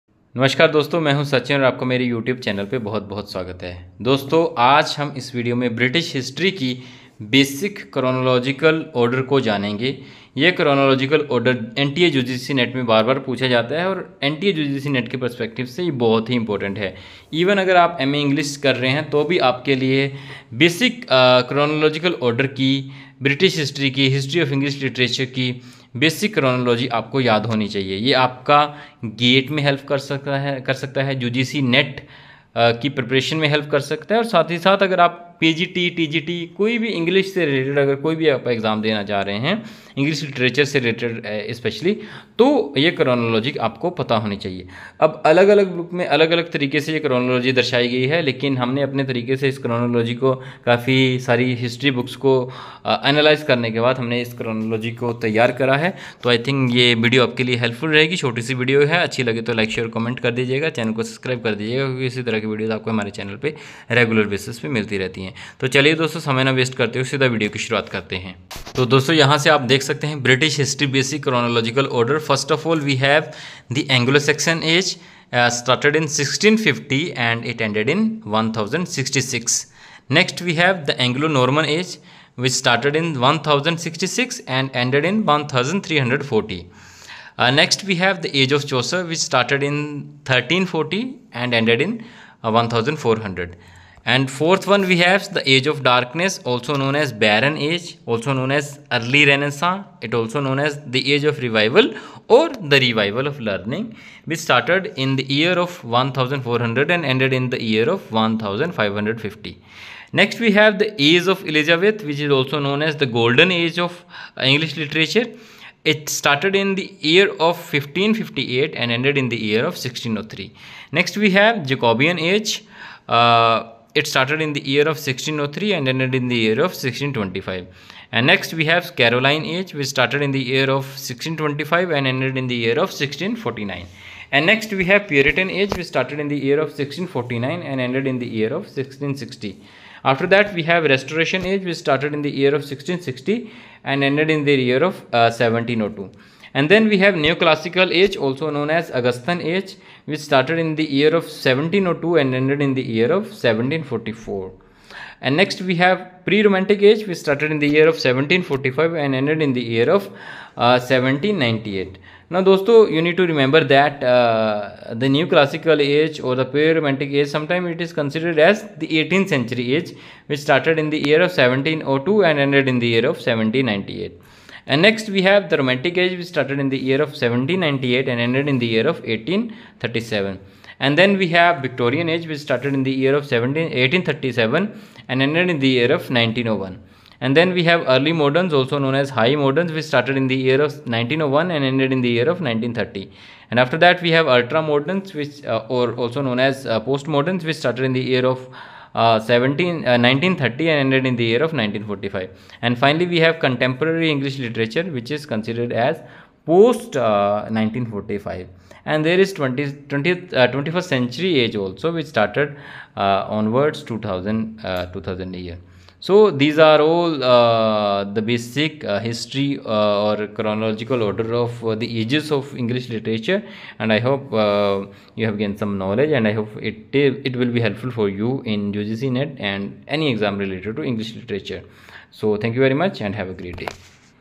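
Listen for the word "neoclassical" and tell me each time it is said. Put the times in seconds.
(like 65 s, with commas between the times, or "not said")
147 s, 165 s.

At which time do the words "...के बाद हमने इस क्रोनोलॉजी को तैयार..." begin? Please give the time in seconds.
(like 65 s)
53 s.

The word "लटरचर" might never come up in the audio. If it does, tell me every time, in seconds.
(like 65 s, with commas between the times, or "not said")
24 s, 40 s.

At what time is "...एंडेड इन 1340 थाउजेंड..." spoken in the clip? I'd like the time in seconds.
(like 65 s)
84 s.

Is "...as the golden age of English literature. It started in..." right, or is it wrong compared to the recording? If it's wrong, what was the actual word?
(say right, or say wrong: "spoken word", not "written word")
right.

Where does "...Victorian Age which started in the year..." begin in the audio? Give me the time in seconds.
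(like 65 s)
181 s.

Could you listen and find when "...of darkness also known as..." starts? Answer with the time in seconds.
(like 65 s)
95 s.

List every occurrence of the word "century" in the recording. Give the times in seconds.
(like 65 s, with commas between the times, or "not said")
169 s, 210 s.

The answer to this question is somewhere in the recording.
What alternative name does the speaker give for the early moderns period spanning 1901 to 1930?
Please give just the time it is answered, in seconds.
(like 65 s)
189 s.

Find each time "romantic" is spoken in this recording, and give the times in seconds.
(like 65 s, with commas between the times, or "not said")
156 s, 166 s, 175 s.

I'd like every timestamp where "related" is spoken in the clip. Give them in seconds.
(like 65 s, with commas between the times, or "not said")
230 s.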